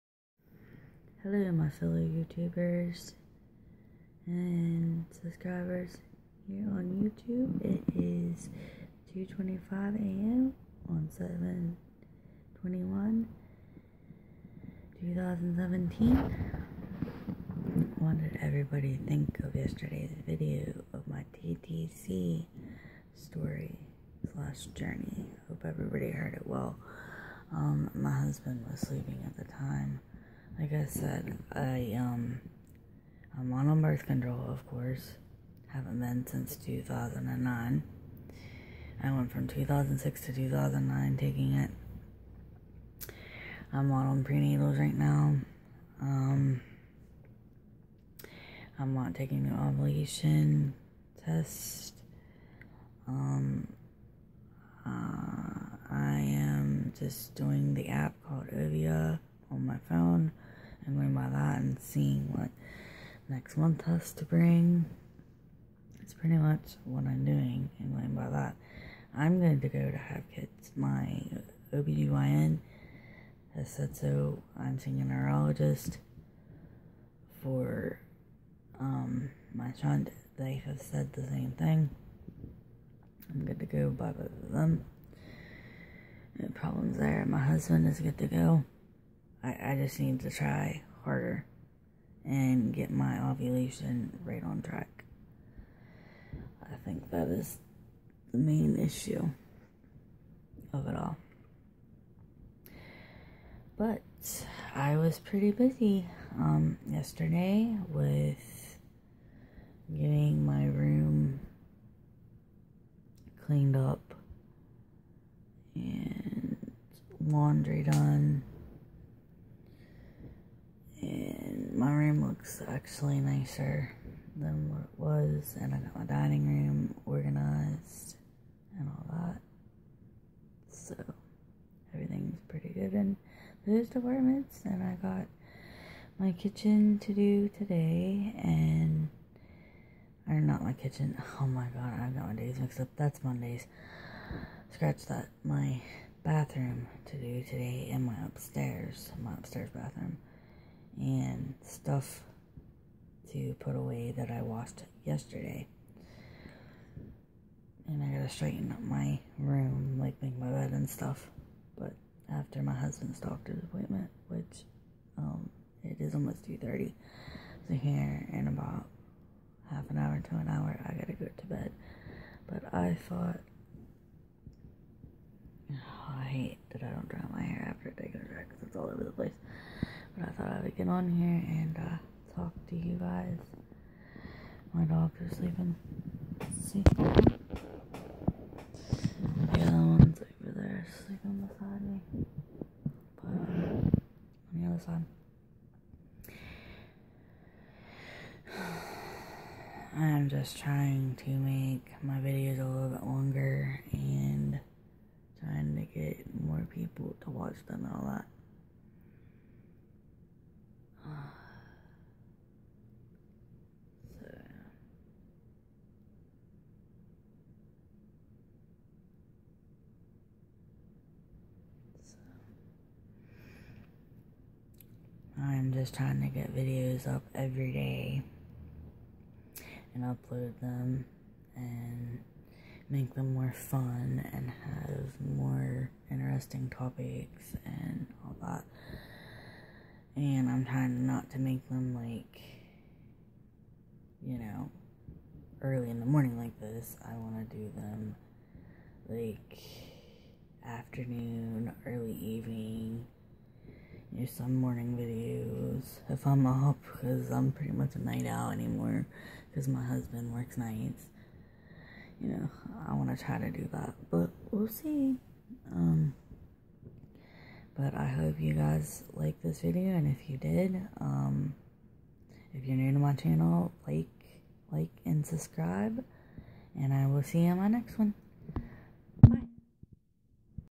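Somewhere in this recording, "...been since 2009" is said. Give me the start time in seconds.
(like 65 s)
35 s.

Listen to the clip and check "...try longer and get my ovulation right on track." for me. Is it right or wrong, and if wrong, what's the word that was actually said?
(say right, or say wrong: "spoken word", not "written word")
wrong: "harder", not "longer".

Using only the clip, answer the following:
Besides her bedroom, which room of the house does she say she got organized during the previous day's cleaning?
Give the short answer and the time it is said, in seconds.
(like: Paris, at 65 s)
dining room, at 126 s.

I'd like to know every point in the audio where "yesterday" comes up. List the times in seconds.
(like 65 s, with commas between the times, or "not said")
19 s, 106 s, 155 s.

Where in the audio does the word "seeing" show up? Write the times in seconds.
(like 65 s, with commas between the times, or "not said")
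61 s, 74 s.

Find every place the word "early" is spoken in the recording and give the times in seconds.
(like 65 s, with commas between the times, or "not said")
245 s, 251 s.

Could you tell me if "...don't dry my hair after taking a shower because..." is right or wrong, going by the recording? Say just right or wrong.
right.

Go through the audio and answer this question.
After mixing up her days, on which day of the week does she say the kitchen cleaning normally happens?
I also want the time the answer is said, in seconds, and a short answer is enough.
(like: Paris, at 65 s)
Mondays, at 143 s.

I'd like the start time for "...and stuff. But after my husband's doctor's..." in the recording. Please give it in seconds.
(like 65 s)
160 s.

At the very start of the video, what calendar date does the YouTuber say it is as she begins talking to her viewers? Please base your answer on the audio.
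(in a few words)
7/21/2017.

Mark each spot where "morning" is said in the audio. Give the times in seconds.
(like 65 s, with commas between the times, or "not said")
246 s, 254 s.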